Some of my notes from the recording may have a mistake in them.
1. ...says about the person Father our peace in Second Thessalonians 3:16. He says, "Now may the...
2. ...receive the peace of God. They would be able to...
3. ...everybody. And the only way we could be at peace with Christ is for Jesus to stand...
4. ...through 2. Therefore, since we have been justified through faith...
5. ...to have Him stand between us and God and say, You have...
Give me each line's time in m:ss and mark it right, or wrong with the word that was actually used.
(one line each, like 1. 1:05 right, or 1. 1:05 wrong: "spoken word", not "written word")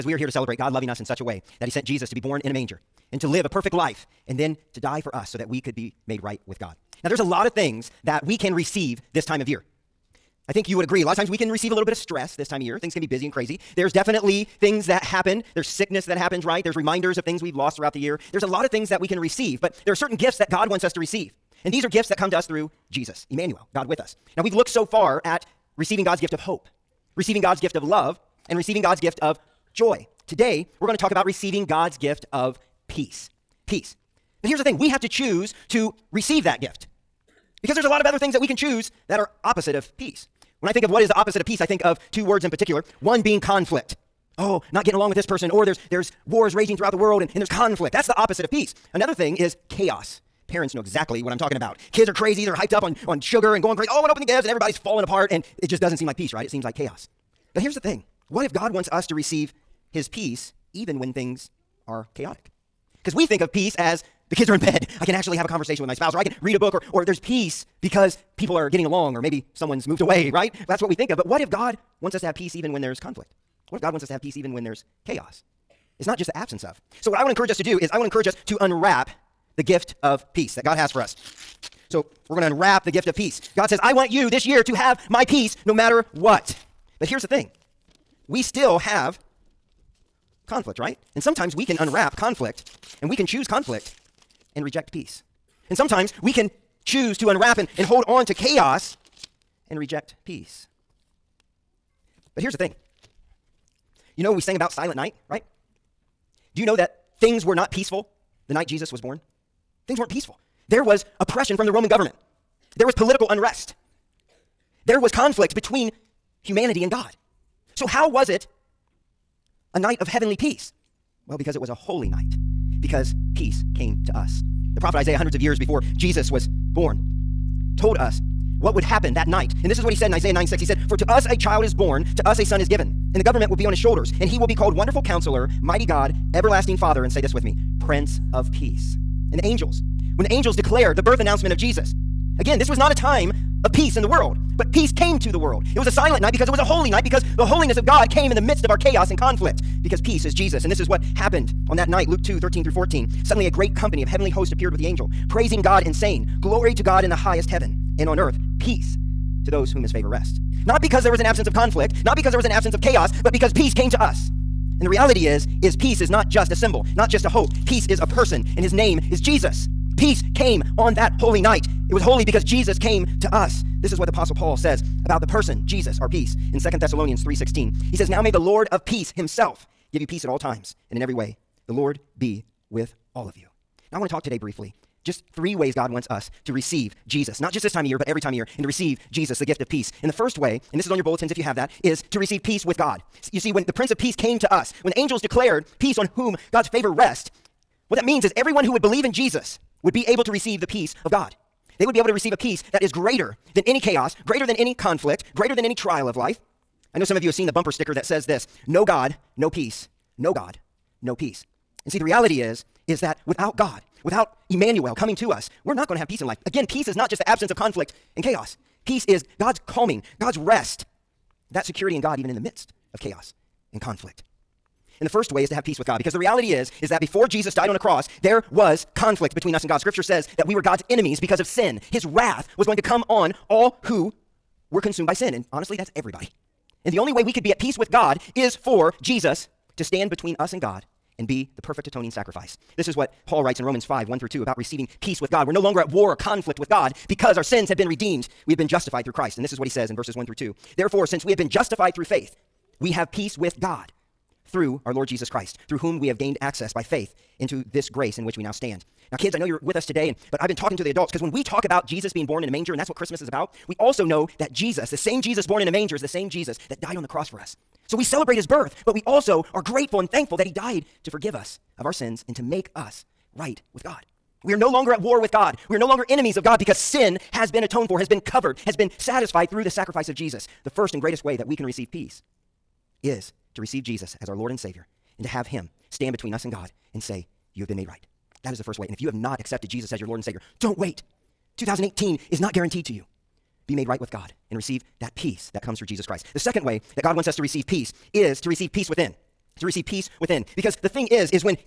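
1. 2:54 wrong: "Jesus", not "Father"
2. 3:20 right
3. 3:55 wrong: "God", not "Christ"
4. 4:10 right
5. 4:45 right.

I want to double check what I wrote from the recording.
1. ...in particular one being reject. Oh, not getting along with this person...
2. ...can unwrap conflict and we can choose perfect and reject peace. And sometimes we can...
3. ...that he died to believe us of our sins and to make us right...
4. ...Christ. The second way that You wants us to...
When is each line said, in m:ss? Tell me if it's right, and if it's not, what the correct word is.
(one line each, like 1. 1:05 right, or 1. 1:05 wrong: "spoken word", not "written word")
1. 0:42 wrong: "conflict", not "reject"
2. 1:31 wrong: "conflict", not "perfect"
3. 4:30 wrong: "forgive", not "believe"
4. 4:56 wrong: "God", not "You".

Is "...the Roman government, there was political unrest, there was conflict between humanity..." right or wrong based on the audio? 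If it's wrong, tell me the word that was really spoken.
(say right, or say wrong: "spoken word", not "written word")
right.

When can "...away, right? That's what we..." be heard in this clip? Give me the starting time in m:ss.
1:10.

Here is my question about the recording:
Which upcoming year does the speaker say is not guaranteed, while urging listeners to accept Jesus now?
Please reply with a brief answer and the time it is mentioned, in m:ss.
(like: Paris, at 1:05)
2018, at 4:51.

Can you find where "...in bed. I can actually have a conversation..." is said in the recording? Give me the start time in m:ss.
1:04.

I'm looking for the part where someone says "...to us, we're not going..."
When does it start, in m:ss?
3:35.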